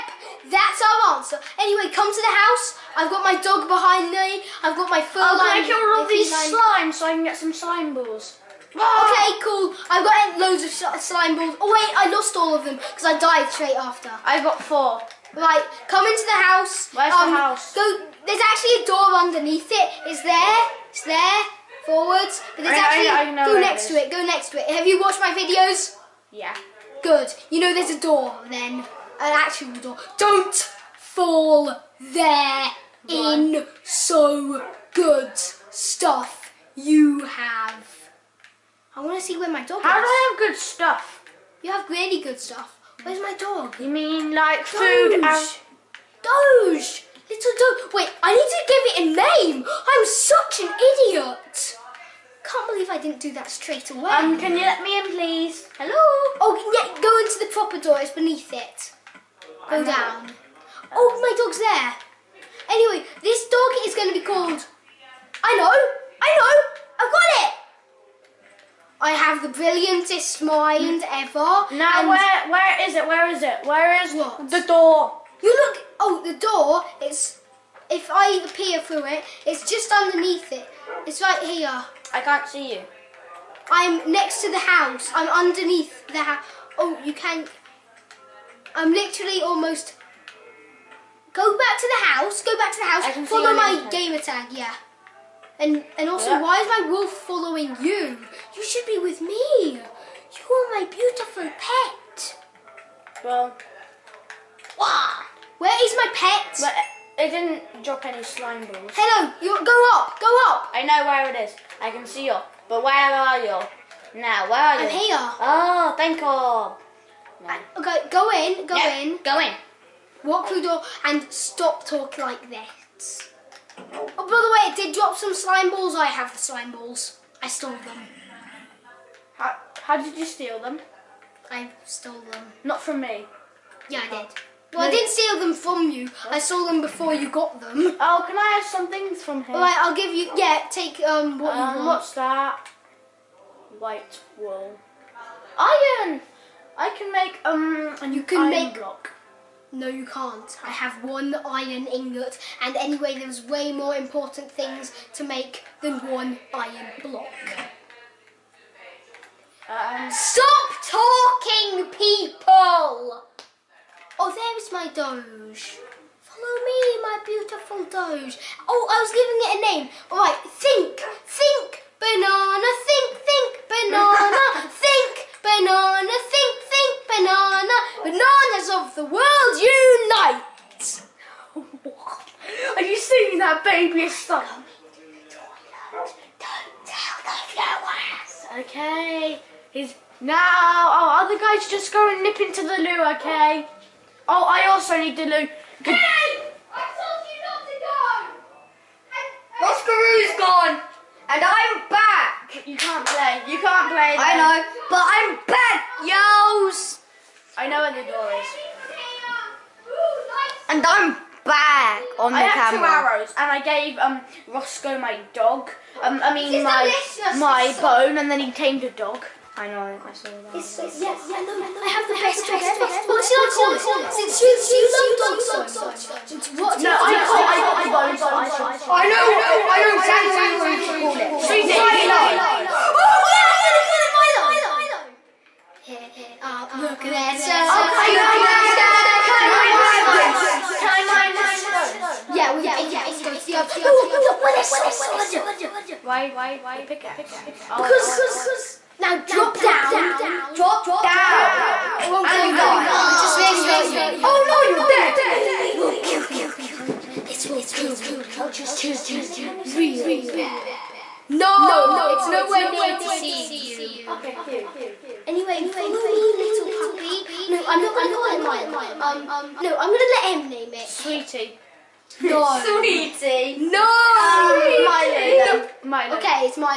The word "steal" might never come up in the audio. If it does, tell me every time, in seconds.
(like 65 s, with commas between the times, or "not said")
130 s, 135 s.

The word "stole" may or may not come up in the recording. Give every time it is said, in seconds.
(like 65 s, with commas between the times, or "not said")
127 s, 131 s, 136 s.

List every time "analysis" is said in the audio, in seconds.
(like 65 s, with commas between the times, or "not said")
not said.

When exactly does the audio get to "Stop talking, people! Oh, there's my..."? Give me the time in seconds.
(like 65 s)
160 s.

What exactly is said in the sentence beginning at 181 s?
Are you singing that babyish song?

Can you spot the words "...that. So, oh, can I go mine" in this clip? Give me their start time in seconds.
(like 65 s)
237 s.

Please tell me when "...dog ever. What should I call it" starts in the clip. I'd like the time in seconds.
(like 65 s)
222 s.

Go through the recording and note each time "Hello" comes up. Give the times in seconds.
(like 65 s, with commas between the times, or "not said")
55 s, 108 s.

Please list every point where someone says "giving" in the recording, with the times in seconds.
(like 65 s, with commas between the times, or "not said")
169 s.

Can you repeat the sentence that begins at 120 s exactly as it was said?
Walk through the door and stop talking like this.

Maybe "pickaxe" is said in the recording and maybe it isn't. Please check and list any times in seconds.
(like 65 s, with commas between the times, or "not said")
242 s, 246 s.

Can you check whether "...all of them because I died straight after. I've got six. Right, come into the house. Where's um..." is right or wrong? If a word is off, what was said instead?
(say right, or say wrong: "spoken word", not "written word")
wrong: "four", not "six".